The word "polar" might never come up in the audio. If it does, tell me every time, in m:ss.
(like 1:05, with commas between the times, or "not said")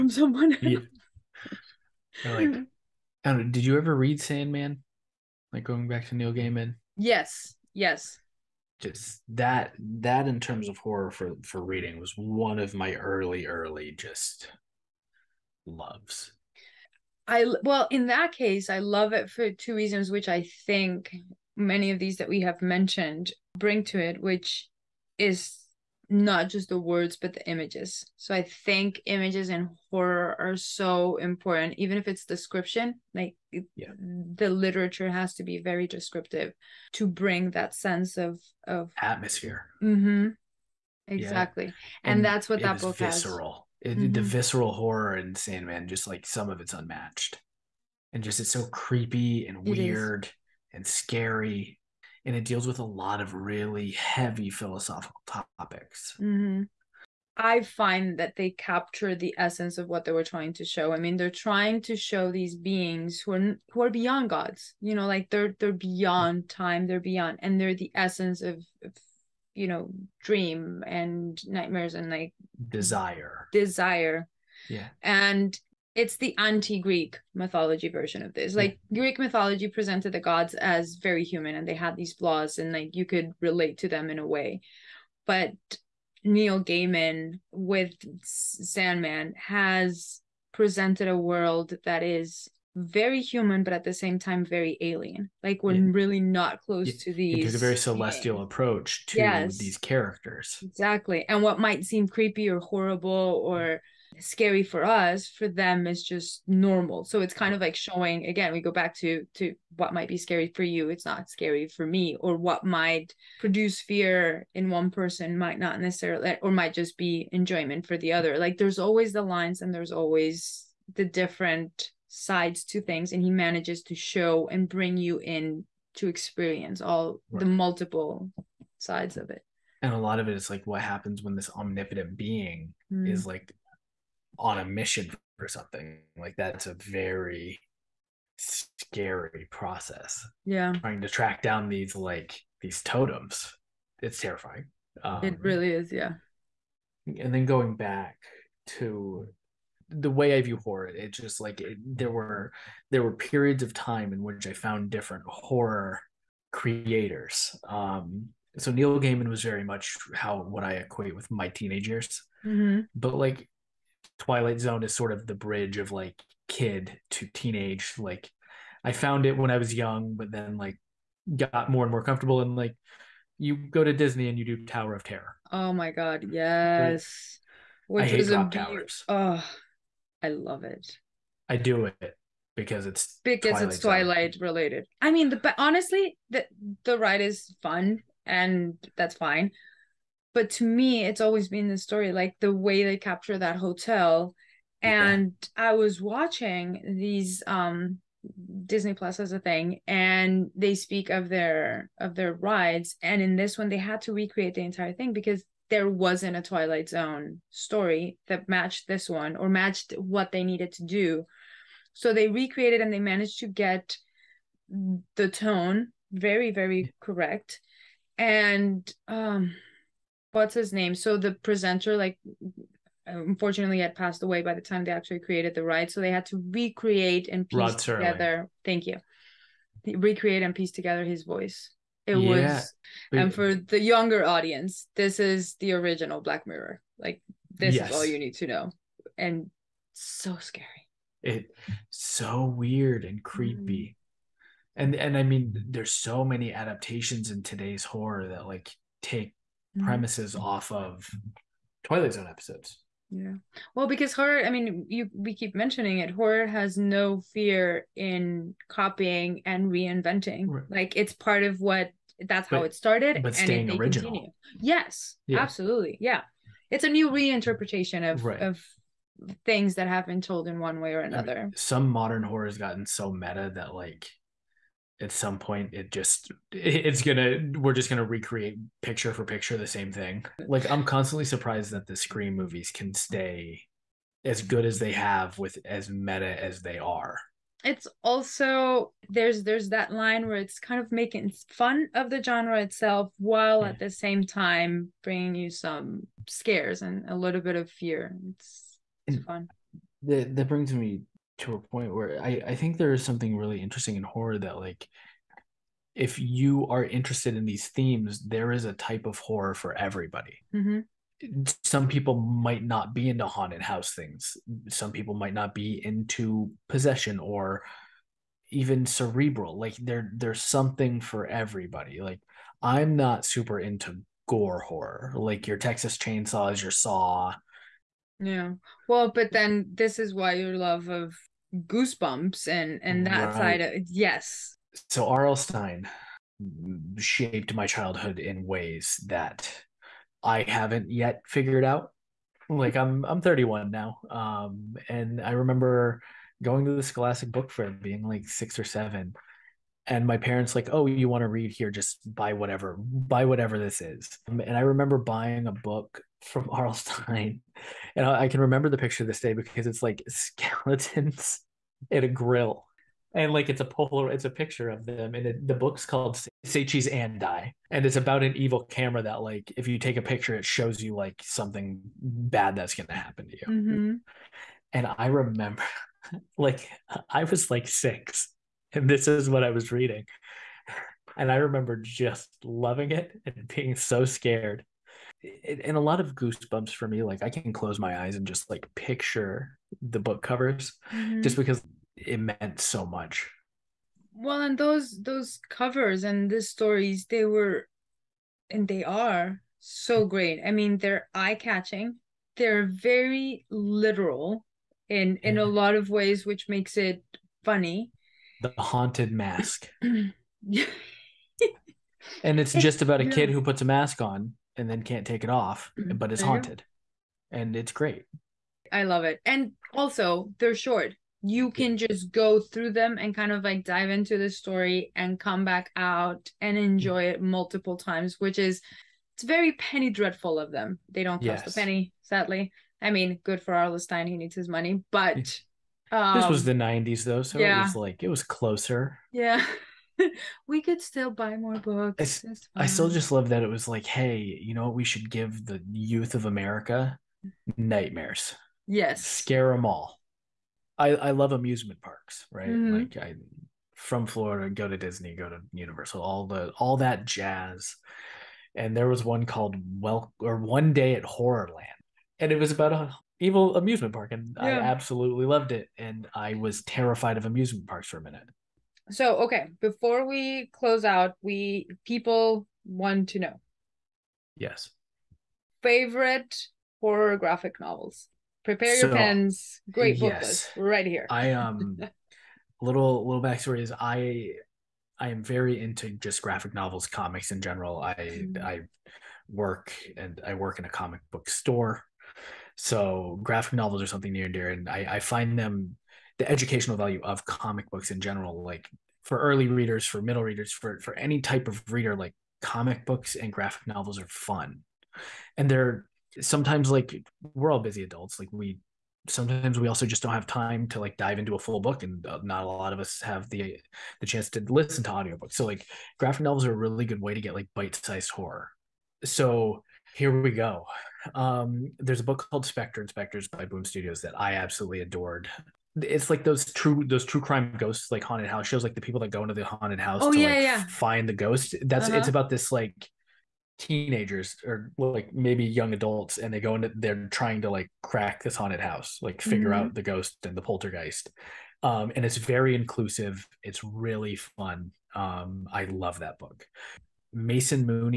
6:03.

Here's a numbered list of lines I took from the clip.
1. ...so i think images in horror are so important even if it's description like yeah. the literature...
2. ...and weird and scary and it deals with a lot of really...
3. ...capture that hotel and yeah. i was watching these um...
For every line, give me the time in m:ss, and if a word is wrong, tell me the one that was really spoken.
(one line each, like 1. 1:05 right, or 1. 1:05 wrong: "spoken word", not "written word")
1. 0:28 right
2. 0:49 right
3. 3:12 right.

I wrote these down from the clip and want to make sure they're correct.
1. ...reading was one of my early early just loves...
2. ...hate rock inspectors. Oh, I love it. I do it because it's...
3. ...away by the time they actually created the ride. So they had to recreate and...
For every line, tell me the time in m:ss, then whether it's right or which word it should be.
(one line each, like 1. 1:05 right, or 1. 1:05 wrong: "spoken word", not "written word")
1. 0:11 right
2. 2:58 wrong: "towers", not "inspectors"
3. 3:44 right.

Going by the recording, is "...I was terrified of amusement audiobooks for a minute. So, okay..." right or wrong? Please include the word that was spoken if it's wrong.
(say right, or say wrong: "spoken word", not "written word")
wrong: "parks", not "audiobooks".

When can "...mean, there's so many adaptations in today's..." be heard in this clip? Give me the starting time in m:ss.
4:05.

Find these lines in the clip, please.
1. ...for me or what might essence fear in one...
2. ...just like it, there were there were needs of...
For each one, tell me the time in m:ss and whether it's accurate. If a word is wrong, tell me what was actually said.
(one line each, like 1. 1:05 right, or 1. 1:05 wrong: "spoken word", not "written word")
1. 1:51 wrong: "produce", not "essence"
2. 2:31 wrong: "periods", not "needs".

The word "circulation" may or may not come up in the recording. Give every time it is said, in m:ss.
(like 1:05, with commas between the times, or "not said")
not said.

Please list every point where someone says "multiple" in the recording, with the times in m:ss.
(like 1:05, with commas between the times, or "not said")
2:07, 7:07.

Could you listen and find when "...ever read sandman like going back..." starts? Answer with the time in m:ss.
0:03.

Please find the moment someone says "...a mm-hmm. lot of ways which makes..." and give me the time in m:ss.
6:45.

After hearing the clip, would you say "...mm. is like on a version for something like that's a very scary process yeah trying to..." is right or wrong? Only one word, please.
wrong.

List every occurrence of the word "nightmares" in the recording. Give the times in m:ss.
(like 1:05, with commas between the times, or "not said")
1:11, 7:27.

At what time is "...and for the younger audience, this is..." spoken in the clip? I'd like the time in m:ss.
3:53.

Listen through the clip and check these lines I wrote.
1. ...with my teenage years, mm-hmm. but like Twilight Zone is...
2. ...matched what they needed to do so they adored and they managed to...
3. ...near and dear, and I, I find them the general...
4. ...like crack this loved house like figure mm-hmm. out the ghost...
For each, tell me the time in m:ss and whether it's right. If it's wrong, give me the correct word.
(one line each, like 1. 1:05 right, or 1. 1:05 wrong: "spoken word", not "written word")
1. 2:41 right
2. 3:29 wrong: "recreated", not "adored"
3. 8:14 wrong: "educational", not "general"
4. 8:57 wrong: "haunted", not "loved".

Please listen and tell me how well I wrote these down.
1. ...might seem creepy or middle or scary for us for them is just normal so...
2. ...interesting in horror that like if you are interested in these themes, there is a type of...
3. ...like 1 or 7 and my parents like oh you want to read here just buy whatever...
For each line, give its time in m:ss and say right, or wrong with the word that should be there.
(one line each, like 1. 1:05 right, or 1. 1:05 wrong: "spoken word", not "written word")
1. 1:41 wrong: "horrible", not "middle"
2. 5:03 right
3. 5:48 wrong: "6", not "1".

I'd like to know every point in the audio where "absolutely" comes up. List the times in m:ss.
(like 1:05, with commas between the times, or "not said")
4:25, 7:44, 8:44.